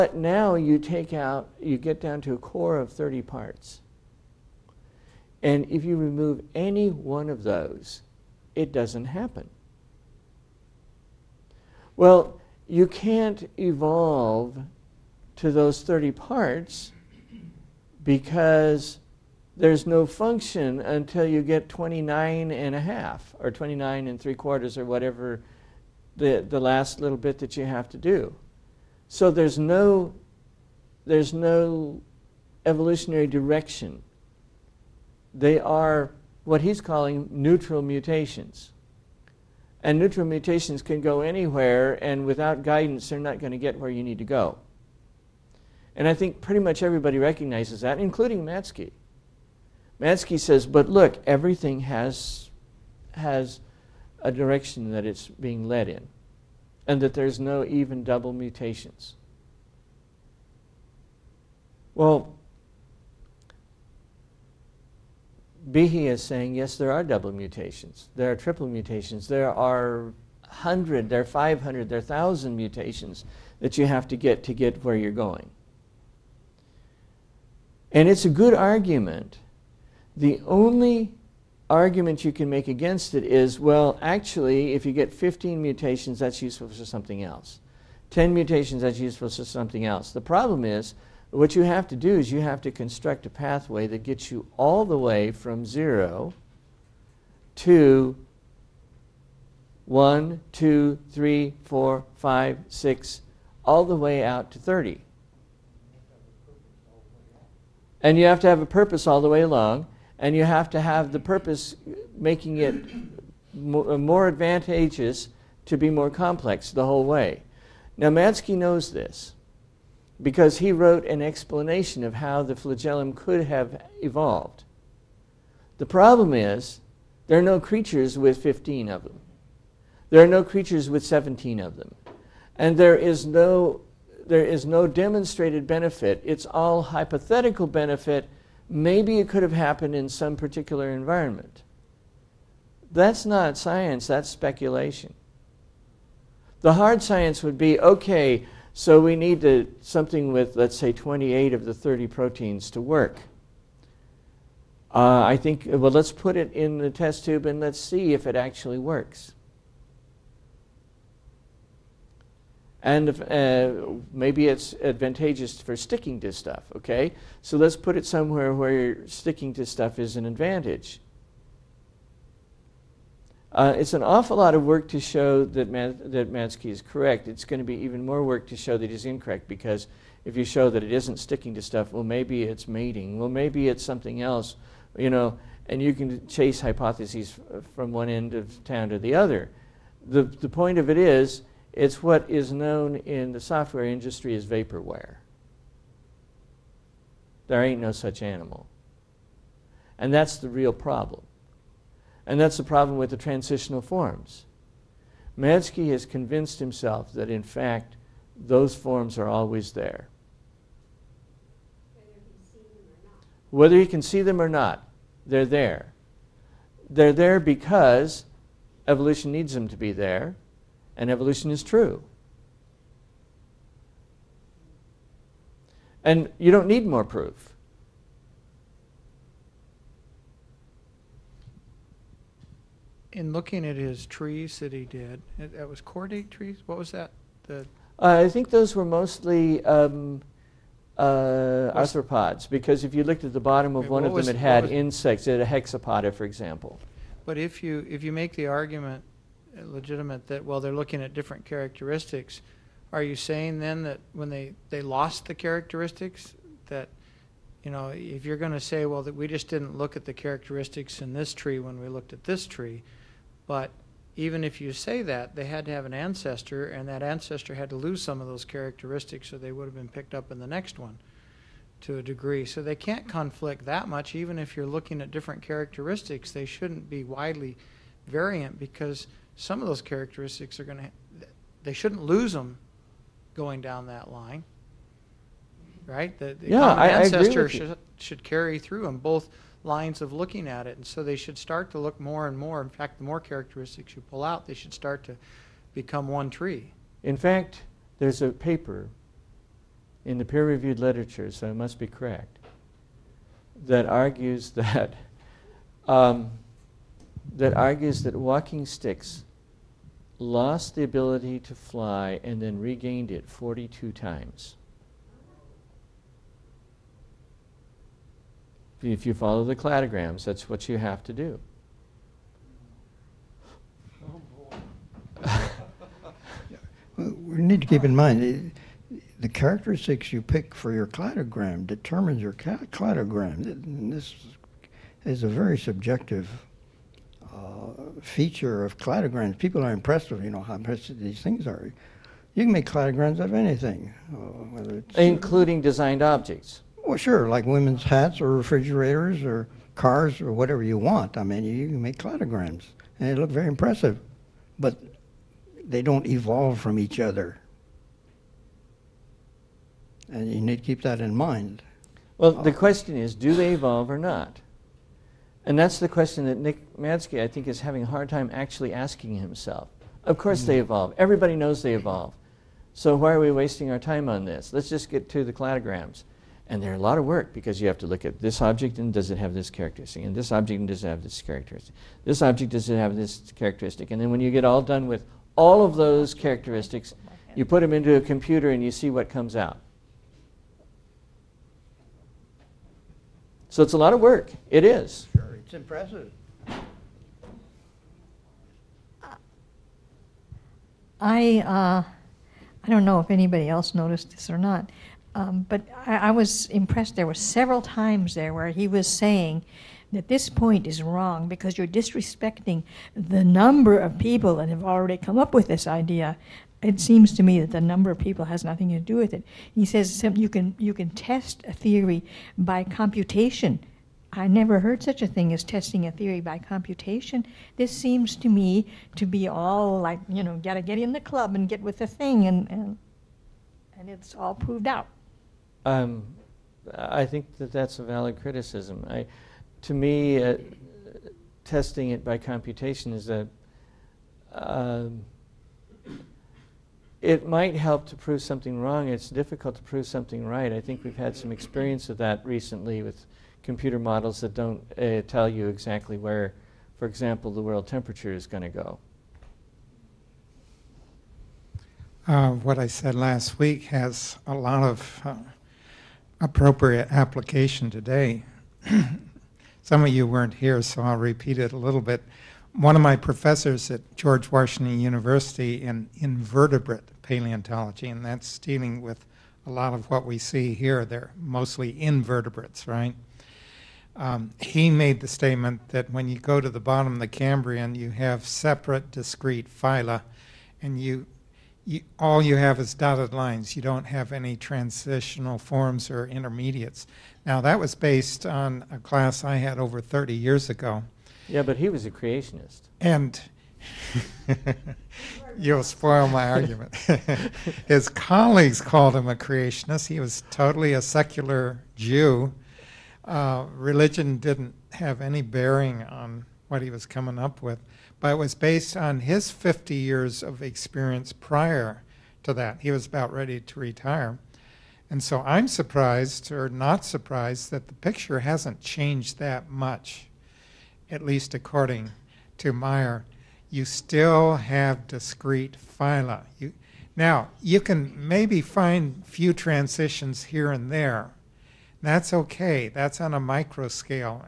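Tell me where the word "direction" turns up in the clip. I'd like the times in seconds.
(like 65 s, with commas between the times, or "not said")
33 s, 54 s.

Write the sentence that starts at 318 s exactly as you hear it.
If you follow the cladograms, that's what you have to do.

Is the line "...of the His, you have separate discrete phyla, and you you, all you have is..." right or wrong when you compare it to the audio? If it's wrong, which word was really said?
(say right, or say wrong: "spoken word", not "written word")
wrong: "Cambrian", not "His".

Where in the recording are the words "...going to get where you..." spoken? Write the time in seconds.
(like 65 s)
43 s.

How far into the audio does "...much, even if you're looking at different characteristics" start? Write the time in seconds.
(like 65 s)
273 s.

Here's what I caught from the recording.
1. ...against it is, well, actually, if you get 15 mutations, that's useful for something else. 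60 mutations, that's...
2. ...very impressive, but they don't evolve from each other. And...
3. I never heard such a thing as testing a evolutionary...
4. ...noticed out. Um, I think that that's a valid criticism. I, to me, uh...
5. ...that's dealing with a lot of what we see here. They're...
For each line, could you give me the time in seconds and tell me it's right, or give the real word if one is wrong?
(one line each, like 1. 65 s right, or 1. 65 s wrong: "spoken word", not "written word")
1. 82 s wrong: "10", not "60"
2. 353 s right
3. 424 s wrong: "theory", not "evolutionary"
4. 434 s wrong: "proved", not "noticed"
5. 478 s right.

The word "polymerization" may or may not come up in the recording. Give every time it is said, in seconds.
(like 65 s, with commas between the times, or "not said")
not said.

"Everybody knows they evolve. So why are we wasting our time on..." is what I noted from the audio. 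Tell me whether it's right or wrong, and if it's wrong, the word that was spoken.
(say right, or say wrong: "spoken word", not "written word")
right.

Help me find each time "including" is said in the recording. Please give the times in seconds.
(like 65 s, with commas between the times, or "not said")
47 s, 345 s.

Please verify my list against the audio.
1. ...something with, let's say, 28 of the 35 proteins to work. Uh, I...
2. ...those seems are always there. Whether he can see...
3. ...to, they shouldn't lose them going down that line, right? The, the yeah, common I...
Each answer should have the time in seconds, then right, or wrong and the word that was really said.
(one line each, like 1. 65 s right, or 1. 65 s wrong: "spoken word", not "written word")
1. 149 s wrong: "30", not "35"
2. 208 s wrong: "forms", not "seems"
3. 280 s right.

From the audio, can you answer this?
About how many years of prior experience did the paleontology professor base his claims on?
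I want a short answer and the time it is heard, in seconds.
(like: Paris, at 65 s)
50, at 519 s.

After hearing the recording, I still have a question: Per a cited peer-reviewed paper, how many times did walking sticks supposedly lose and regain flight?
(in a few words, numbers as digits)
42.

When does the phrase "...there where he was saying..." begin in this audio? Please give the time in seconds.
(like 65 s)
408 s.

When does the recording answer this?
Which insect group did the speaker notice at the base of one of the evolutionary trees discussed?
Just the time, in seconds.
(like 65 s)
245 s.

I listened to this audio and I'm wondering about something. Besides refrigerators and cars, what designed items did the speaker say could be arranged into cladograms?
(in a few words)
women's hats.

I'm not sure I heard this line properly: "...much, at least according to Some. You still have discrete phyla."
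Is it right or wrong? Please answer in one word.
wrong.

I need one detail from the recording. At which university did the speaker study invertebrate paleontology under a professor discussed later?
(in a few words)
George Washington University.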